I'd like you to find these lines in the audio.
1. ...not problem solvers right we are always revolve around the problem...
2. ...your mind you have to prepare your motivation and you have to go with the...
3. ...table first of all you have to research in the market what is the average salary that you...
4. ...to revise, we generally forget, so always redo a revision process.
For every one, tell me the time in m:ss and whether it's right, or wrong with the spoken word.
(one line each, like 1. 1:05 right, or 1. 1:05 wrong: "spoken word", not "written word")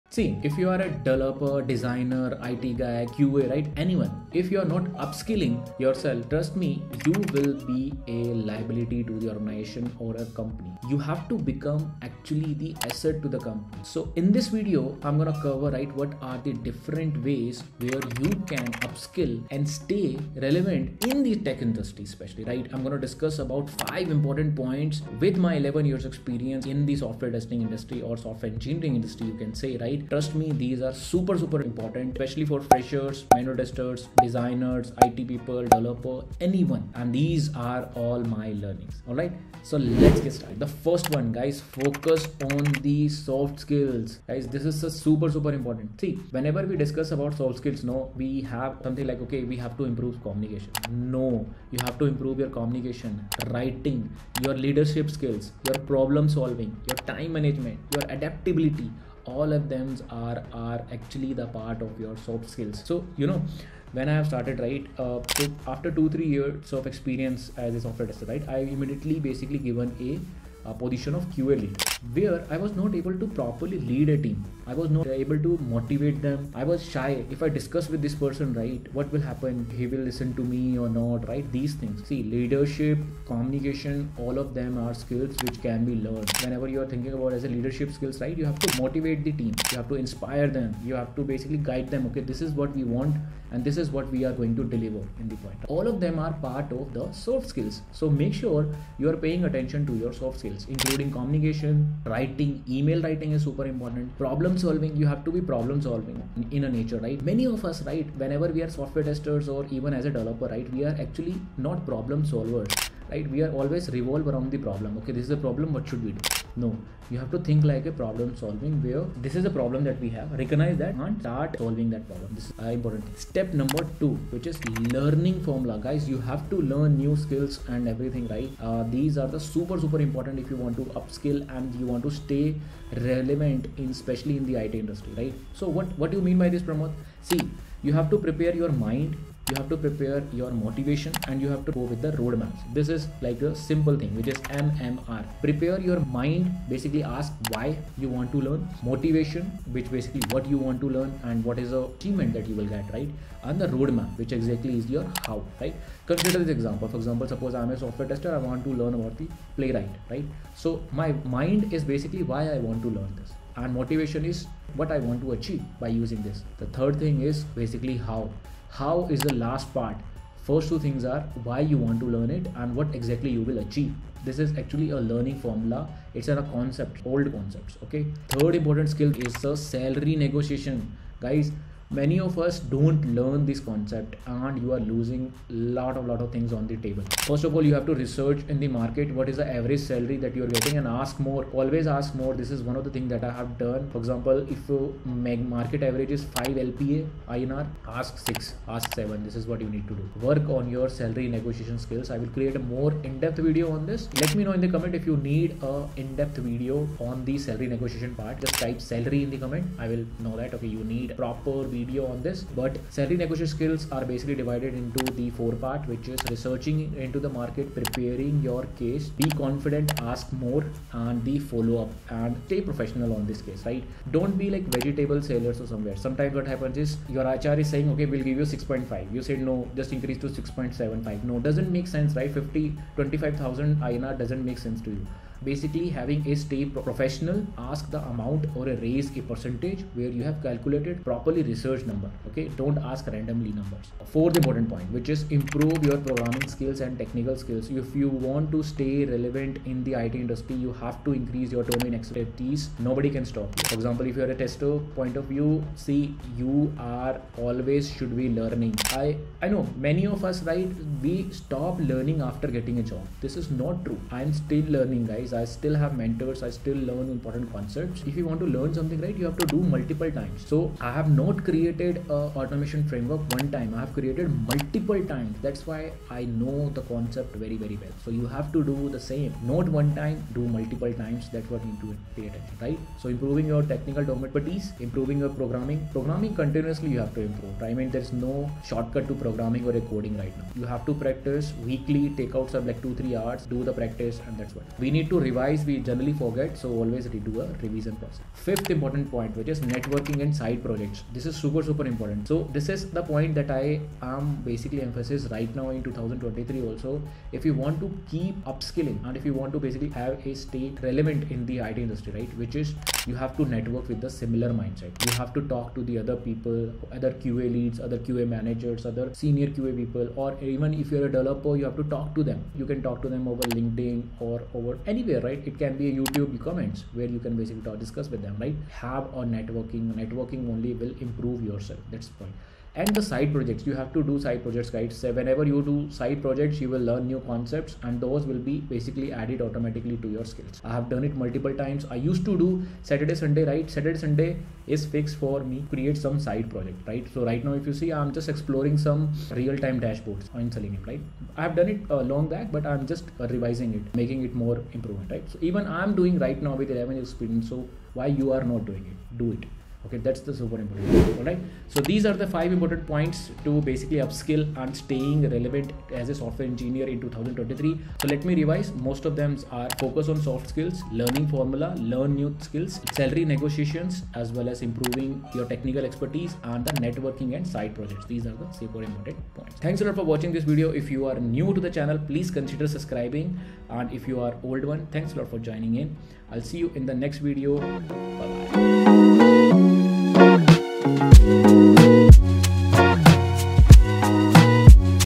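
1. 1:51 right
2. 2:18 right
3. 3:06 right
4. 4:55 right.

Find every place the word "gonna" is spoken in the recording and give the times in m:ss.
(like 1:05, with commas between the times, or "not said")
0:15, 0:22.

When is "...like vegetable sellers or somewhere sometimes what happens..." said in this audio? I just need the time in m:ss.
3:44.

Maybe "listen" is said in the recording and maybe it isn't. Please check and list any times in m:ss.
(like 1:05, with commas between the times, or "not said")
1:20.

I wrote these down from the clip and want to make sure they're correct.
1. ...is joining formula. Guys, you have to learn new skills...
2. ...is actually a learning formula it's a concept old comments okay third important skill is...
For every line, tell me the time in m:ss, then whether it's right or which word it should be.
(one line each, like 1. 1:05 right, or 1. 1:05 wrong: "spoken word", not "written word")
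1. 2:04 wrong: "learning", not "joining"
2. 2:54 wrong: "concepts", not "comments".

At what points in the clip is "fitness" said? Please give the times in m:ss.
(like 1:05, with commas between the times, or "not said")
not said.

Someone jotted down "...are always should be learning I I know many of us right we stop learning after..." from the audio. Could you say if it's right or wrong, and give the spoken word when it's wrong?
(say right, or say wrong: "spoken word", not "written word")
right.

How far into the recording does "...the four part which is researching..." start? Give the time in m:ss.
3:35.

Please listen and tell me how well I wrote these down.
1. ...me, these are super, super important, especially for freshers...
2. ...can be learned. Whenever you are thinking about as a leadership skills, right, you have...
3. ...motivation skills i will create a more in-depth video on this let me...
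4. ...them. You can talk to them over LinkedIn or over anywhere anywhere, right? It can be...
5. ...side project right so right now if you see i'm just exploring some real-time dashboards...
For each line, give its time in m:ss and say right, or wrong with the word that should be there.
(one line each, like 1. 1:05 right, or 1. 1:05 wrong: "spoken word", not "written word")
1. 0:30 right
2. 1:25 right
3. 3:21 wrong: "negotiation", not "motivation"
4. 5:22 right
5. 5:46 right.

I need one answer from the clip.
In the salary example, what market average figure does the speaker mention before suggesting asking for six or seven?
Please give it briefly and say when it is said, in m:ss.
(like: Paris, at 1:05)
5 LPA, at 3:16.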